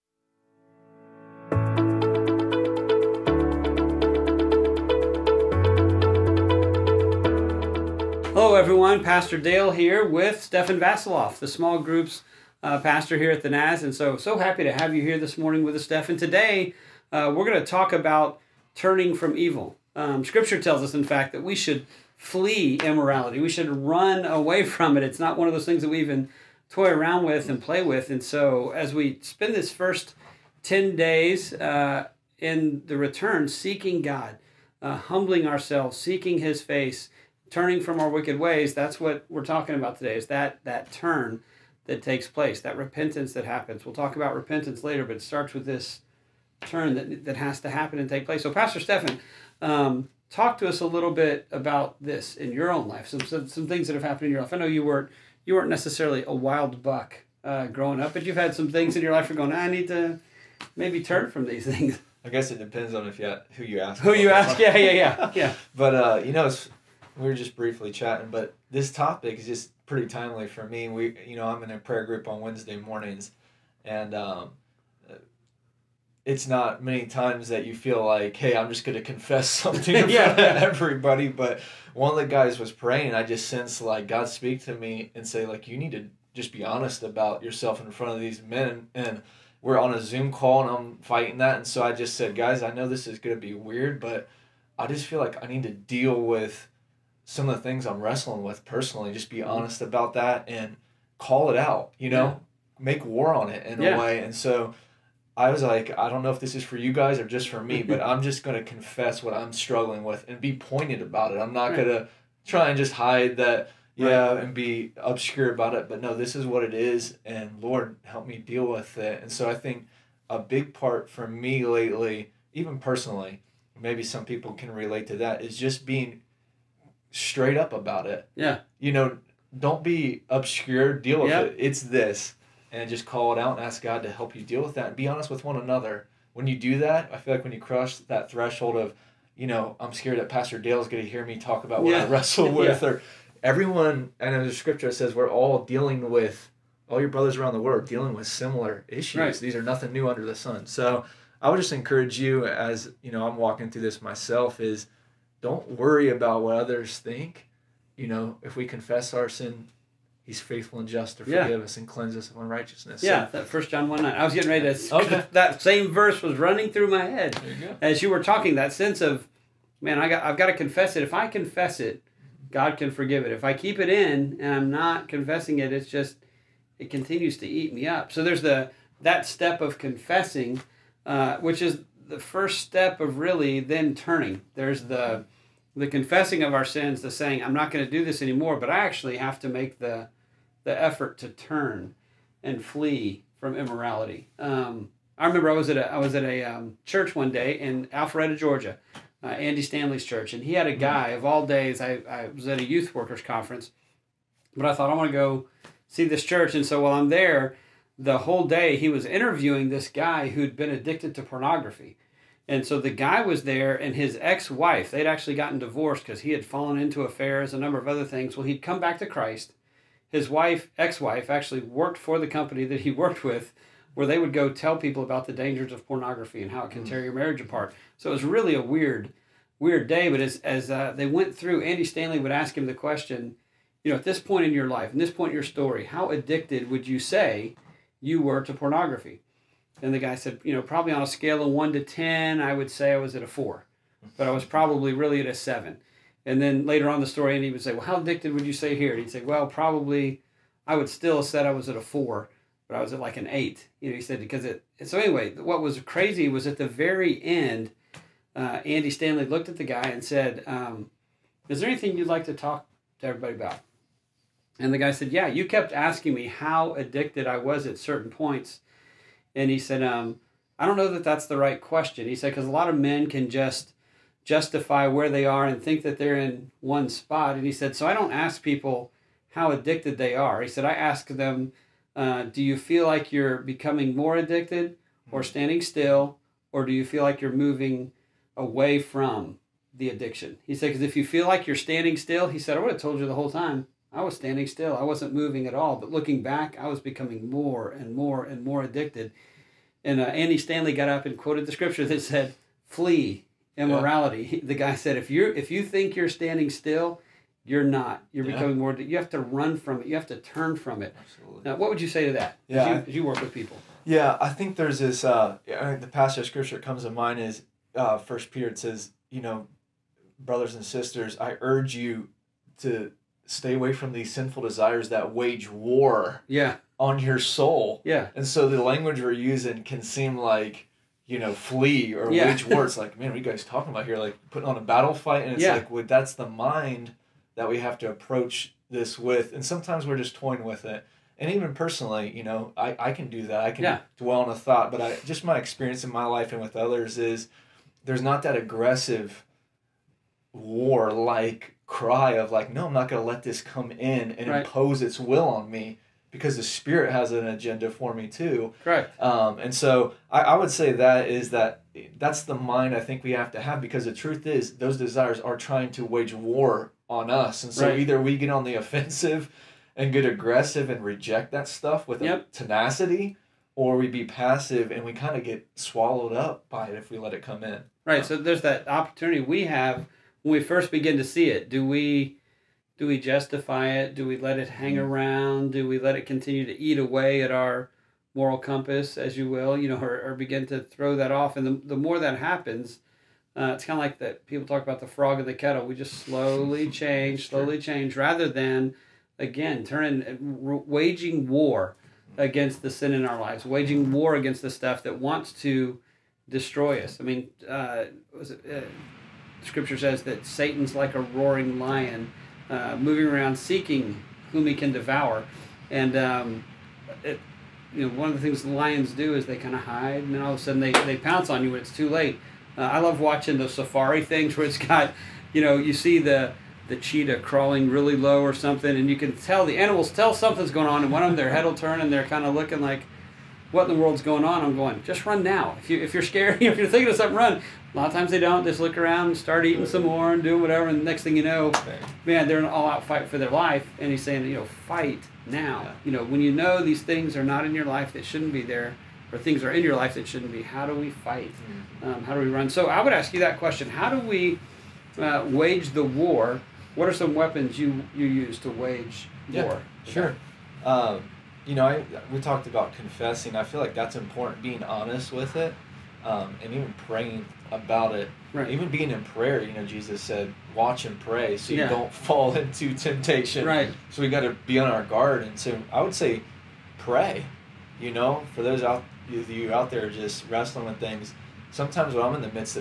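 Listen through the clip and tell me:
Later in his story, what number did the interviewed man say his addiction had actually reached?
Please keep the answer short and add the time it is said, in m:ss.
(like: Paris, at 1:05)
8, at 4:13.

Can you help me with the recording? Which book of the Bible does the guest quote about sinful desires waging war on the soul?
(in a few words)
First Peter.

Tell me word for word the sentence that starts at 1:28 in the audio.
And we're on a Zoom call and I'm fighting that.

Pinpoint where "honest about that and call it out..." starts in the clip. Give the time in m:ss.
1:39.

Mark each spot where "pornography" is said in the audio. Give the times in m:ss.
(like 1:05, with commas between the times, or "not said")
3:31, 3:45, 3:58.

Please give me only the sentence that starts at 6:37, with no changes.
change rather than again turning uh, waging war against the sin in our lives waging mm-hmm.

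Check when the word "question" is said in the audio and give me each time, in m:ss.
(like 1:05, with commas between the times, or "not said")
3:52, 4:31, 7:33.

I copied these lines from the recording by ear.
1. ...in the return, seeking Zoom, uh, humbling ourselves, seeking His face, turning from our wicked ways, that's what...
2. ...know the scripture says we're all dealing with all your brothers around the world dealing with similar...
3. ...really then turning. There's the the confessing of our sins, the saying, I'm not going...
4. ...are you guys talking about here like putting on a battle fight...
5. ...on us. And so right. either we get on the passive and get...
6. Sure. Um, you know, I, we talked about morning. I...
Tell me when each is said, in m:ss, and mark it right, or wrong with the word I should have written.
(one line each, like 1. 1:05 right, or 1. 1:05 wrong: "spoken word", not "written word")
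1. 0:32 wrong: "God", not "Zoom"
2. 2:24 right
3. 3:03 right
4. 5:33 right
5. 6:06 wrong: "offensive", not "passive"
6. 7:39 wrong: "confessing", not "morning".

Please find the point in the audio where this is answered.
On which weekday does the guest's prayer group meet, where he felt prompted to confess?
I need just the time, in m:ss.
1:12.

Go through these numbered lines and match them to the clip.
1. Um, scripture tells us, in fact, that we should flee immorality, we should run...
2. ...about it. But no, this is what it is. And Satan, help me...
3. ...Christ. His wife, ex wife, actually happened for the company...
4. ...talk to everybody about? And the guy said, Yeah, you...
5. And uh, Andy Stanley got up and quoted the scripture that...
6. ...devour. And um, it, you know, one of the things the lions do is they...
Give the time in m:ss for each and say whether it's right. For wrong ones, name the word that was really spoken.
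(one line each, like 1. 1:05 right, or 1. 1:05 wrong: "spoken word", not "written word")
1. 0:19 right
2. 1:55 wrong: "Lord", not "Satan"
3. 3:39 wrong: "worked", not "happened"
4. 4:22 right
5. 4:59 right
6. 6:54 right.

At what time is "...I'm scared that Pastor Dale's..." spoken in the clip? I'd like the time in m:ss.
2:19.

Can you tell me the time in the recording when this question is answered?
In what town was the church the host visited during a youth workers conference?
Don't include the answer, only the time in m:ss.
3:17.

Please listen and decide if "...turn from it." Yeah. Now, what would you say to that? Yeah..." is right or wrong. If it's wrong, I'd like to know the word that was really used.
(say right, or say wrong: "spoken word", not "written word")
wrong: "Absolutely", not "Yeah".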